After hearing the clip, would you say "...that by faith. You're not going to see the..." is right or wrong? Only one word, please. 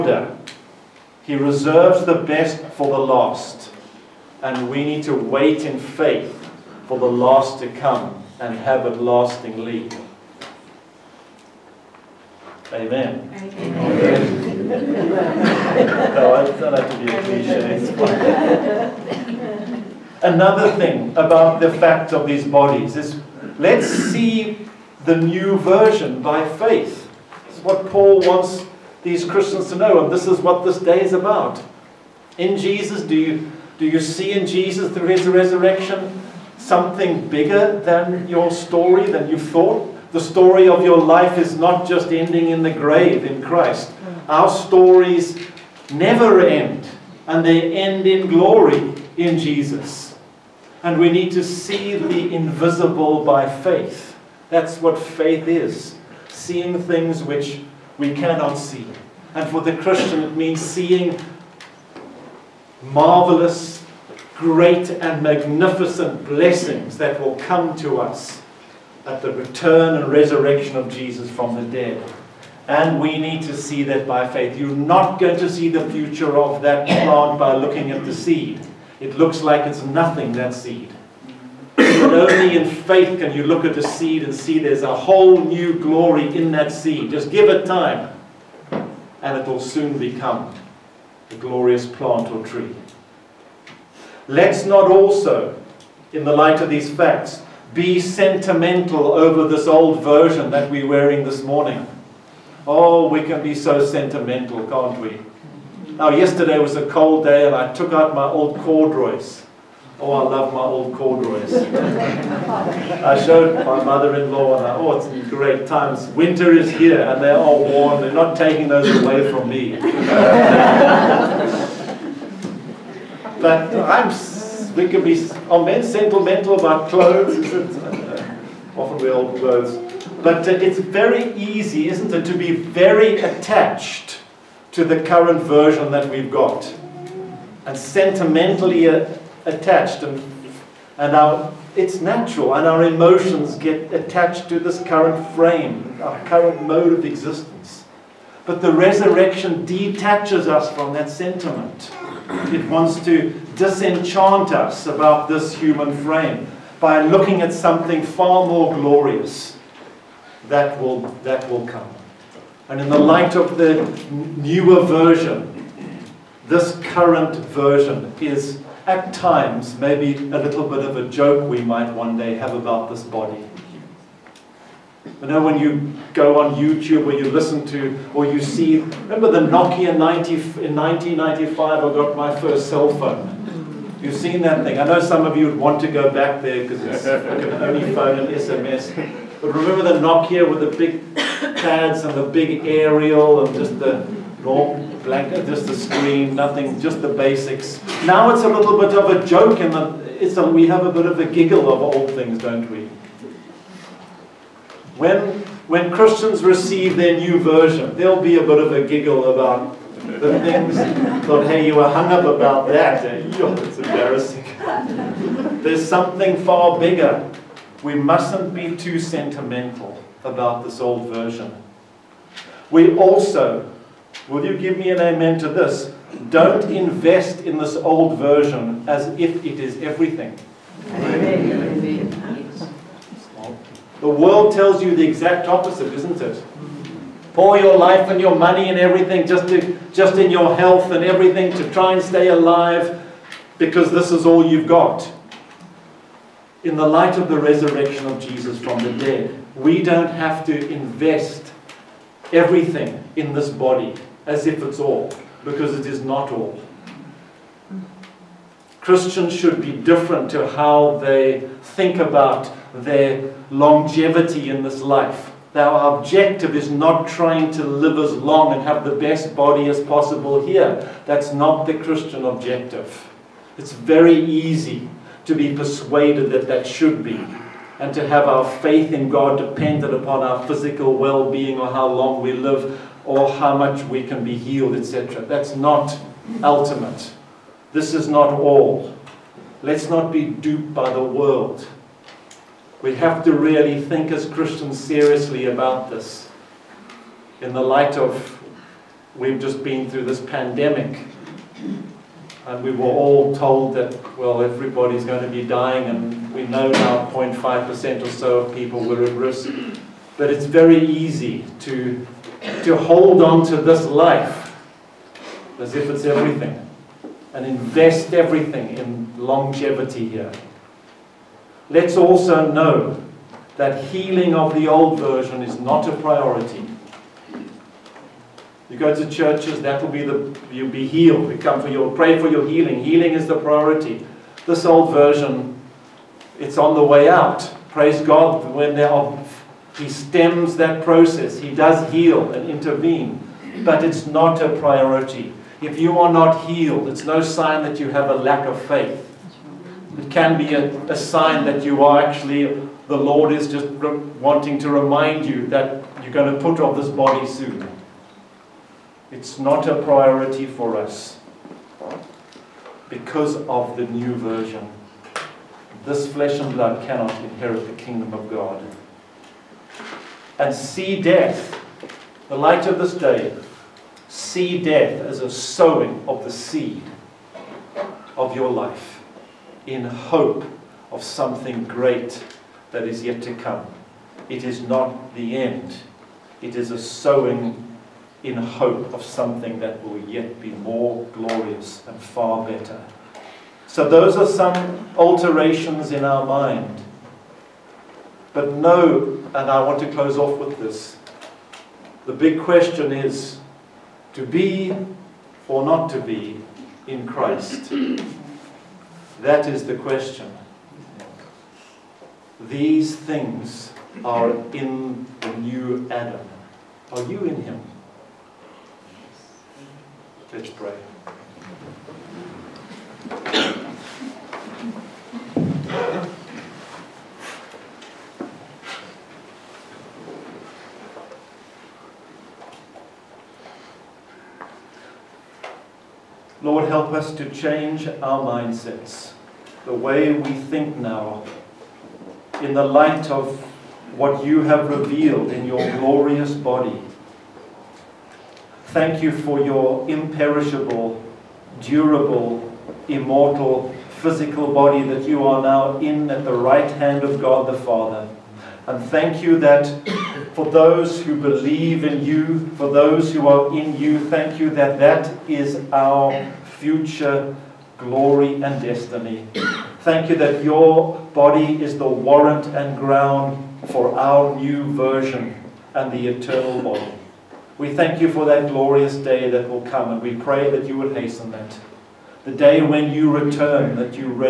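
right.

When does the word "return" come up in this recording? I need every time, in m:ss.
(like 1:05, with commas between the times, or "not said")
1:09, 8:03.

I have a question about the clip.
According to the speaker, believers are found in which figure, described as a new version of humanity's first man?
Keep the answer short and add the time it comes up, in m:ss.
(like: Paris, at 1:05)
the new Adam, at 6:55.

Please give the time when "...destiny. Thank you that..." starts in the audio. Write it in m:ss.
7:48.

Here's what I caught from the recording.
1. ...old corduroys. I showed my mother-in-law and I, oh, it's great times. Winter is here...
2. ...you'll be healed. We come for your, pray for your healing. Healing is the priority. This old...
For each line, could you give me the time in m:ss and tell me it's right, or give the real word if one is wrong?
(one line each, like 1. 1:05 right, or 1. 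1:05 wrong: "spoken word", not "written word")
1. 1:50 right
2. 5:30 right.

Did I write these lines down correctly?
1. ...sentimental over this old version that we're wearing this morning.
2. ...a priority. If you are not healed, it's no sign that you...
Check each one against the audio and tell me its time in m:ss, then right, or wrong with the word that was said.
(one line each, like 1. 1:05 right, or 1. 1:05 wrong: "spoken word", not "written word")
1. 1:37 right
2. 5:44 right.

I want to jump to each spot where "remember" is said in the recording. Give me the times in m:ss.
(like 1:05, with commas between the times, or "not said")
2:58, 3:09.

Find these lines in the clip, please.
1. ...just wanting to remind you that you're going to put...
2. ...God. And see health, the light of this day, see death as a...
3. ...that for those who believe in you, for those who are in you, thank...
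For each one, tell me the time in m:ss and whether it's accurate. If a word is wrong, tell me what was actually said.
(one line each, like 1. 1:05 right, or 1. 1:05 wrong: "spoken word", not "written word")
1. 5:53 right
2. 6:08 wrong: "death", not "health"
3. 7:39 right.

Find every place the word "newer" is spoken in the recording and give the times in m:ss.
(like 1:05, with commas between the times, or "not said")
2:44.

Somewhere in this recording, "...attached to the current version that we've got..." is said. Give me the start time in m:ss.
2:13.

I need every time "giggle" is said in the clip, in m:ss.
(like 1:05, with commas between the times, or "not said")
3:21, 3:28.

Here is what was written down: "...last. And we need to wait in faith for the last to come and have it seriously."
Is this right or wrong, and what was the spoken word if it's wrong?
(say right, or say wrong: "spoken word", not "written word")
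wrong: "lastingly", not "seriously".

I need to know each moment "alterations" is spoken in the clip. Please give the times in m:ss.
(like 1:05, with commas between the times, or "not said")
6:34.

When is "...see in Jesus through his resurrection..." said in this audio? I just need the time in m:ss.
0:34.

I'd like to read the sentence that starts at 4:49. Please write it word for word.
Let's not be duped by the world.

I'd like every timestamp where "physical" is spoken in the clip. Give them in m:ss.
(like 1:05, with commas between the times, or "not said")
4:40, 7:34.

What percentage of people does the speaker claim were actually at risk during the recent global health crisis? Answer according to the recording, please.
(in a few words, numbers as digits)
0.5%.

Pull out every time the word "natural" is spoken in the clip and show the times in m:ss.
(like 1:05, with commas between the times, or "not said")
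2:22.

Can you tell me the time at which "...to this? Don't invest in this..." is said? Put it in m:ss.
3:45.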